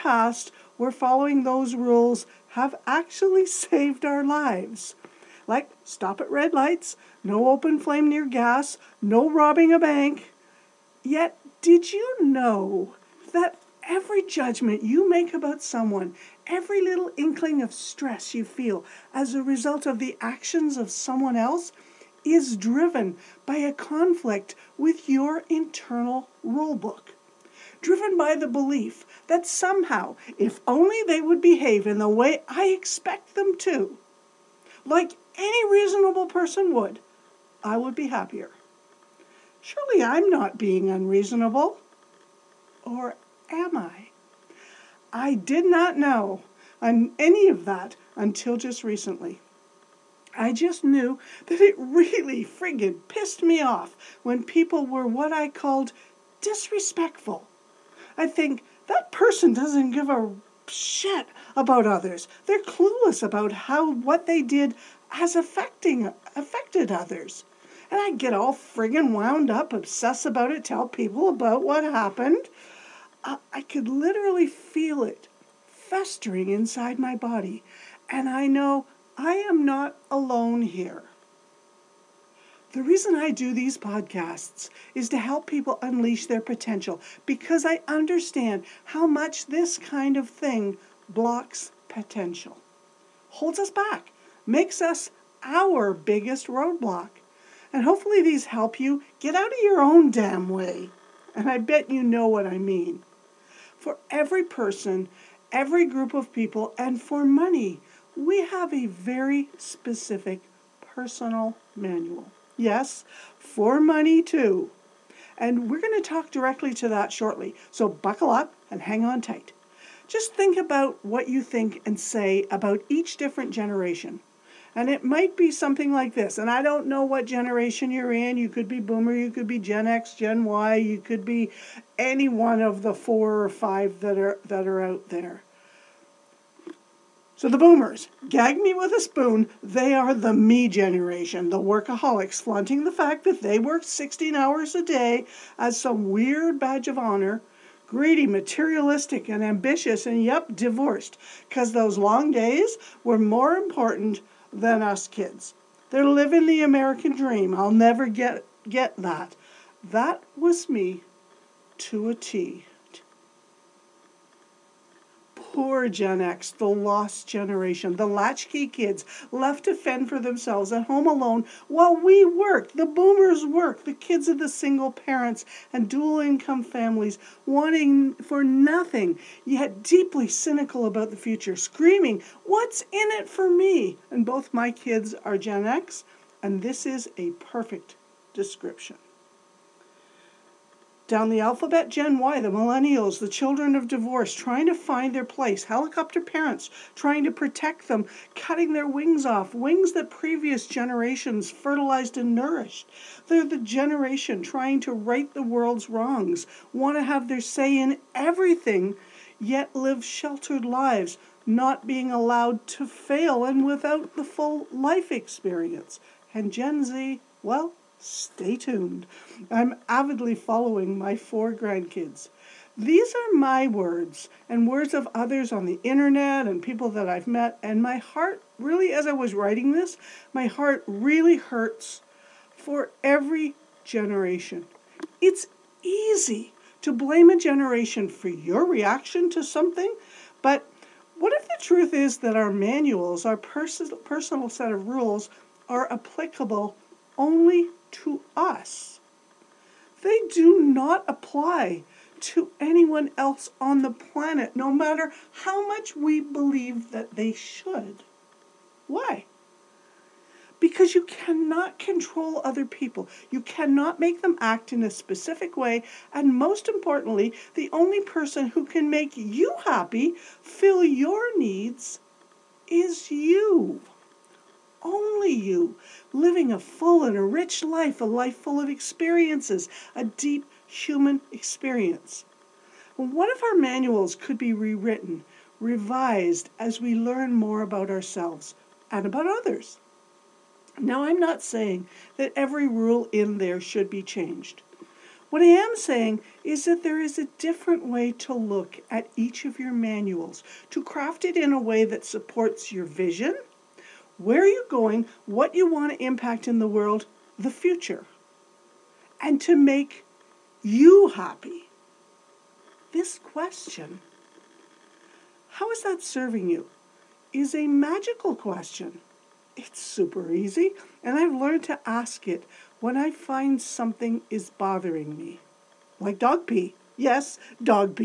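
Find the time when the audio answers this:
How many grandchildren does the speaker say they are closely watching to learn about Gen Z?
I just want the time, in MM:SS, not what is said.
03:41.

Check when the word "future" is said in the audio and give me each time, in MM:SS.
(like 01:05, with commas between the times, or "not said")
03:01, 05:07.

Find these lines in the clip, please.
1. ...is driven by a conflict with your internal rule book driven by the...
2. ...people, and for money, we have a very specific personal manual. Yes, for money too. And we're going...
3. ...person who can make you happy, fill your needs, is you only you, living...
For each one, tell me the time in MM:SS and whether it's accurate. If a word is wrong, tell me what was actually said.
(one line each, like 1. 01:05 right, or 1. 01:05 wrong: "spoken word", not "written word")
1. 00:22 right
2. 01:46 right
3. 04:27 right.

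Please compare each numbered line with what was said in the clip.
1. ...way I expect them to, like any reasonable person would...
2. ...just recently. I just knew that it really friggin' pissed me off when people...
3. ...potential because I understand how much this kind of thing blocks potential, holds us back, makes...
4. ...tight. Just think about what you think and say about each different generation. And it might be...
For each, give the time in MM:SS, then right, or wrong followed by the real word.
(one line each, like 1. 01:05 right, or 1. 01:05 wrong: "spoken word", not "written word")
1. 00:32 right
2. 00:48 right
3. 01:26 right
4. 01:59 right.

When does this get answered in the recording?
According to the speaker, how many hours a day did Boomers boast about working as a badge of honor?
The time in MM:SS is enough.
02:23.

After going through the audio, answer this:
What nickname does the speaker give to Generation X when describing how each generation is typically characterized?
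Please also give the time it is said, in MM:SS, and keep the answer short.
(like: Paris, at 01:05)
the lost generation, at 02:46.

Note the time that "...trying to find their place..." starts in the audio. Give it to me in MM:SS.
03:14.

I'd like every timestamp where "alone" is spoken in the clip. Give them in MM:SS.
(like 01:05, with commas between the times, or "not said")
01:20, 02:51.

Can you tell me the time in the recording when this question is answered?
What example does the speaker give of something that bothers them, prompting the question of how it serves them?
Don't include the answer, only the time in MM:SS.
05:26.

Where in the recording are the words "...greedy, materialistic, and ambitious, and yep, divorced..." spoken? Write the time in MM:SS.
02:27.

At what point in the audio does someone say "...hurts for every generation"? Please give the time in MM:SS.
03:51.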